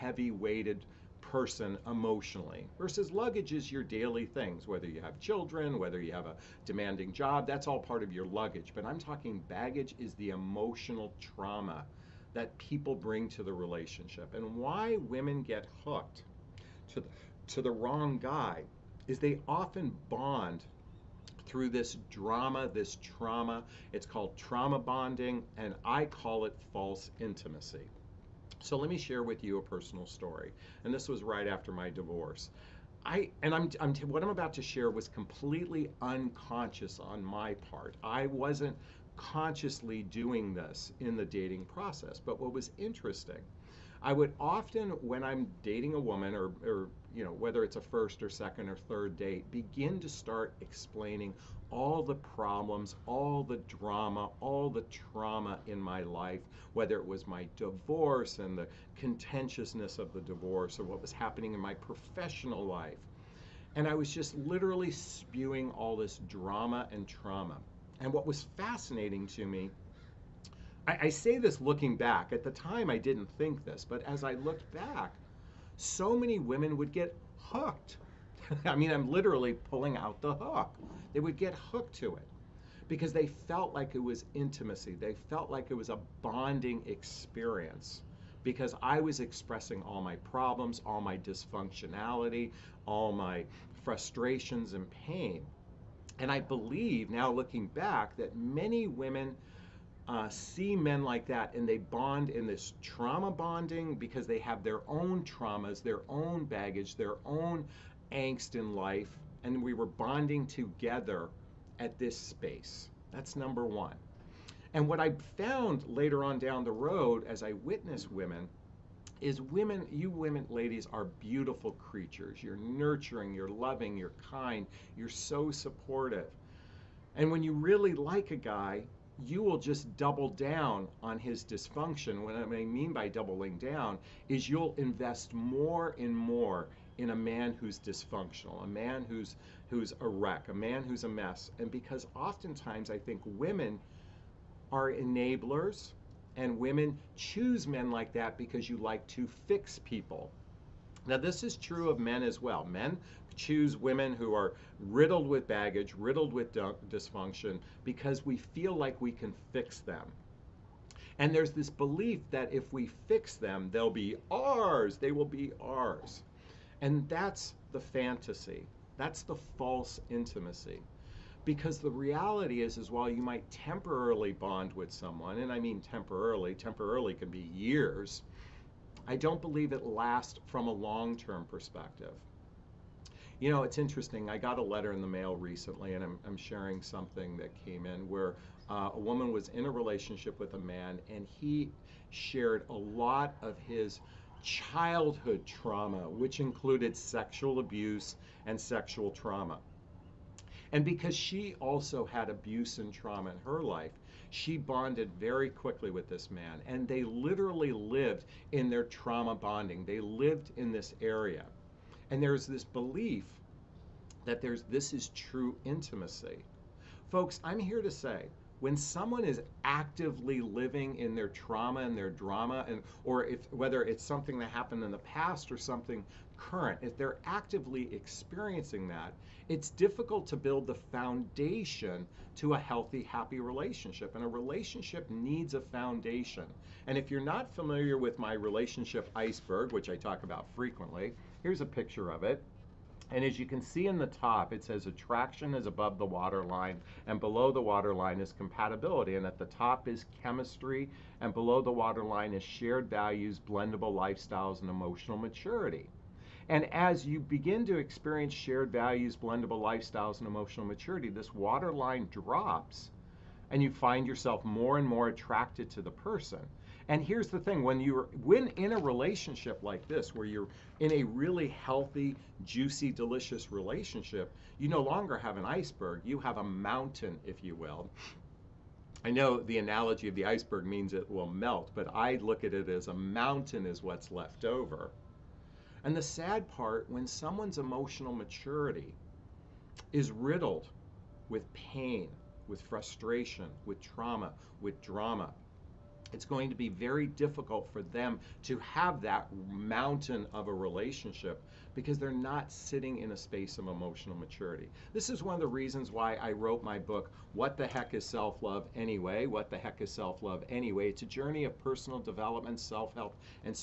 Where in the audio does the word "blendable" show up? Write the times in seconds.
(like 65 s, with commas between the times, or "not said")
253 s, 259 s.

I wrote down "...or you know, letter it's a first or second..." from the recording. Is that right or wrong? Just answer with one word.
wrong.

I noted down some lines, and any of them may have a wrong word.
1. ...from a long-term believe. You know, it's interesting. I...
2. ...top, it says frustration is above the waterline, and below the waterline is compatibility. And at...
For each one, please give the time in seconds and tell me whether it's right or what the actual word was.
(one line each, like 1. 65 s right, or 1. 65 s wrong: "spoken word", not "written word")
1. 180 s wrong: "perspective", not "believe"
2. 244 s wrong: "attraction", not "frustration".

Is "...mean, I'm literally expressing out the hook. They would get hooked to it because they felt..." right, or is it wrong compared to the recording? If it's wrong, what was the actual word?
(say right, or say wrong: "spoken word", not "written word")
wrong: "pulling", not "expressing".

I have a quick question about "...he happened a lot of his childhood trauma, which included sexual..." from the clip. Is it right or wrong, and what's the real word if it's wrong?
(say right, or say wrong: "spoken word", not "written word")
wrong: "shared", not "happened".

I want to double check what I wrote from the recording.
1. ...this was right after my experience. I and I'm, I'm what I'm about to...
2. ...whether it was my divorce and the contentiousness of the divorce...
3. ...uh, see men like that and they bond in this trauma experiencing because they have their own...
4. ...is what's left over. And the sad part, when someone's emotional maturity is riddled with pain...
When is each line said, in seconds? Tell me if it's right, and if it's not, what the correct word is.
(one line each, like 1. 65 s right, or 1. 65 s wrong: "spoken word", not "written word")
1. 30 s wrong: "divorce", not "experience"
2. 56 s right
3. 100 s wrong: "bonding", not "experiencing"
4. 283 s right.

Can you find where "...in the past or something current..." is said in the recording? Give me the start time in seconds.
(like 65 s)
224 s.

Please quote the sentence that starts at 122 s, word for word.
You're nurturing, you're loving, you're kind, you're so supportive.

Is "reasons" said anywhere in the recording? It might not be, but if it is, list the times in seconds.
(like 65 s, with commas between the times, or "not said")
305 s.